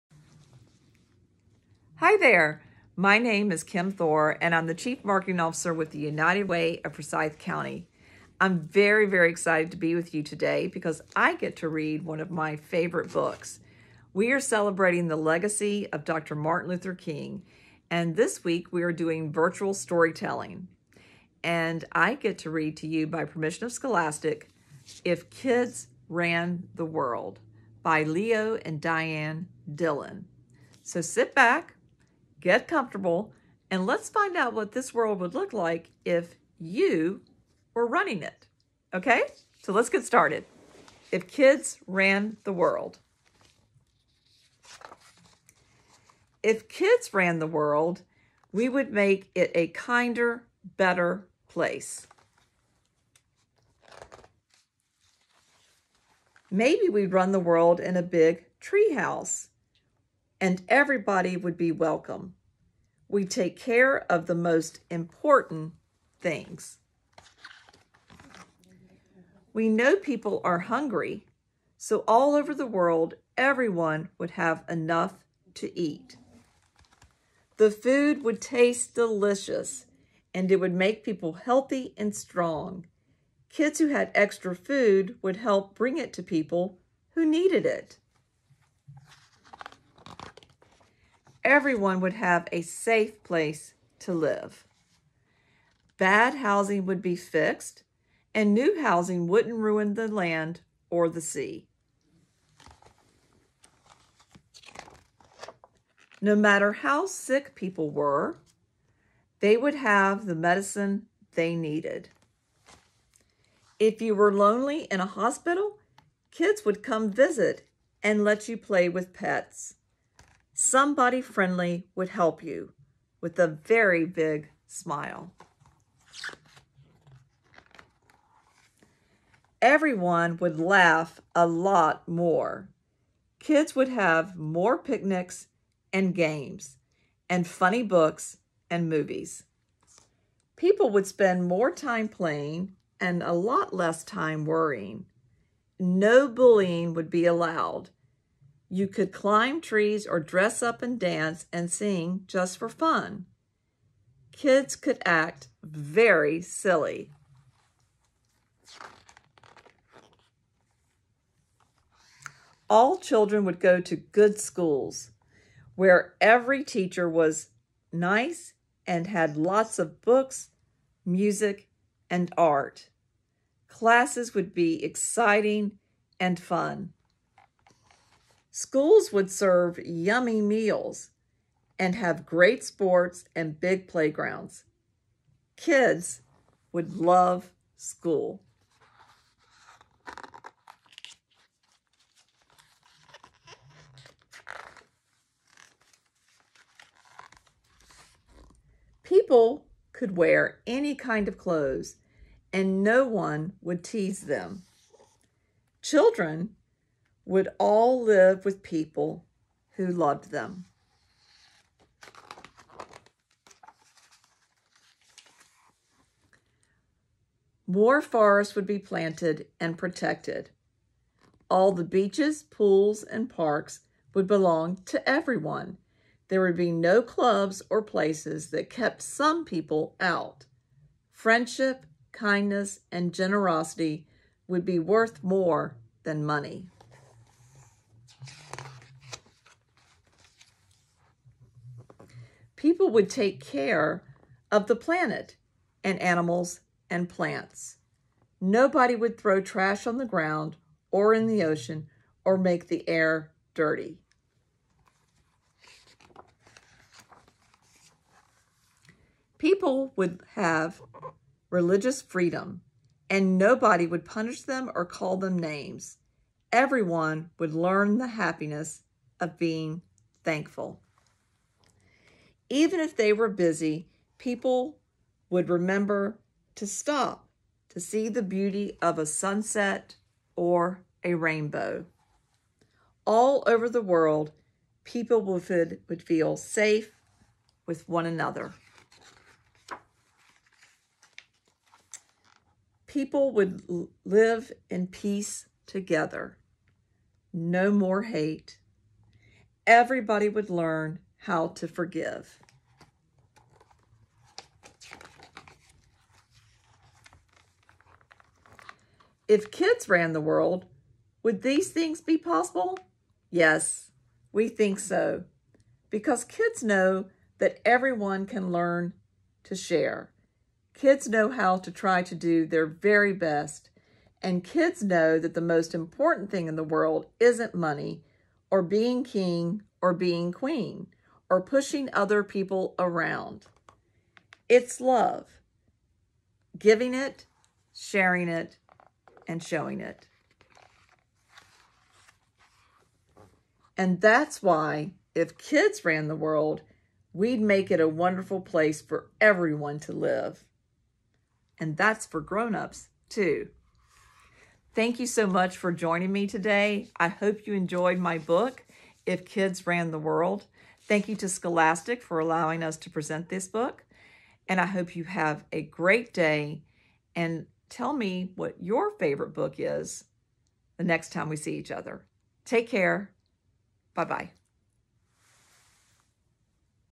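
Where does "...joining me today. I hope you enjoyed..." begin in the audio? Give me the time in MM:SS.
05:55.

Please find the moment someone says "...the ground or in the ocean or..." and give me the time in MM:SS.
04:09.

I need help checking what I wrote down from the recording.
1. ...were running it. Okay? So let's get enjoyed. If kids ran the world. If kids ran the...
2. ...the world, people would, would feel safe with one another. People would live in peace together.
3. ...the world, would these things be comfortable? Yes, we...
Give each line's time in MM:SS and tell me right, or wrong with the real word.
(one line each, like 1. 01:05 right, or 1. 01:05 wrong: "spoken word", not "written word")
1. 00:37 wrong: "started", not "enjoyed"
2. 04:43 right
3. 05:10 wrong: "possible", not "comfortable".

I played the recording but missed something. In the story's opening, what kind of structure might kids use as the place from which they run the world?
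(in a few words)
A big treehouse.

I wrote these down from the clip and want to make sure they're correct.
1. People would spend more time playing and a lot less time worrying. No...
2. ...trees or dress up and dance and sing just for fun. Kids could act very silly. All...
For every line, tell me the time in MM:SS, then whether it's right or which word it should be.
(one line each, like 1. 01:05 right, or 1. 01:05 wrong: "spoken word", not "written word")
1. 02:20 right
2. 02:29 right.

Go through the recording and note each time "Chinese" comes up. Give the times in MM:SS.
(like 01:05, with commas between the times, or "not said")
not said.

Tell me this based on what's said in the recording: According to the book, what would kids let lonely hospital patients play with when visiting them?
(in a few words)
Pets.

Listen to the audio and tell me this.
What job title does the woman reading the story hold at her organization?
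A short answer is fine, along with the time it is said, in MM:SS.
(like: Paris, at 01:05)
Chief Marketing Officer, at 00:04.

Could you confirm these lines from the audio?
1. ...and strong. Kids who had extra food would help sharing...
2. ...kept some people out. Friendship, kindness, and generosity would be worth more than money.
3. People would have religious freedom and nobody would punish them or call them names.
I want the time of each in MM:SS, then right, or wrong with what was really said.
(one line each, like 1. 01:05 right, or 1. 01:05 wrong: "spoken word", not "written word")
1. 01:21 wrong: "bring", not "sharing"
2. 03:48 right
3. 04:19 right.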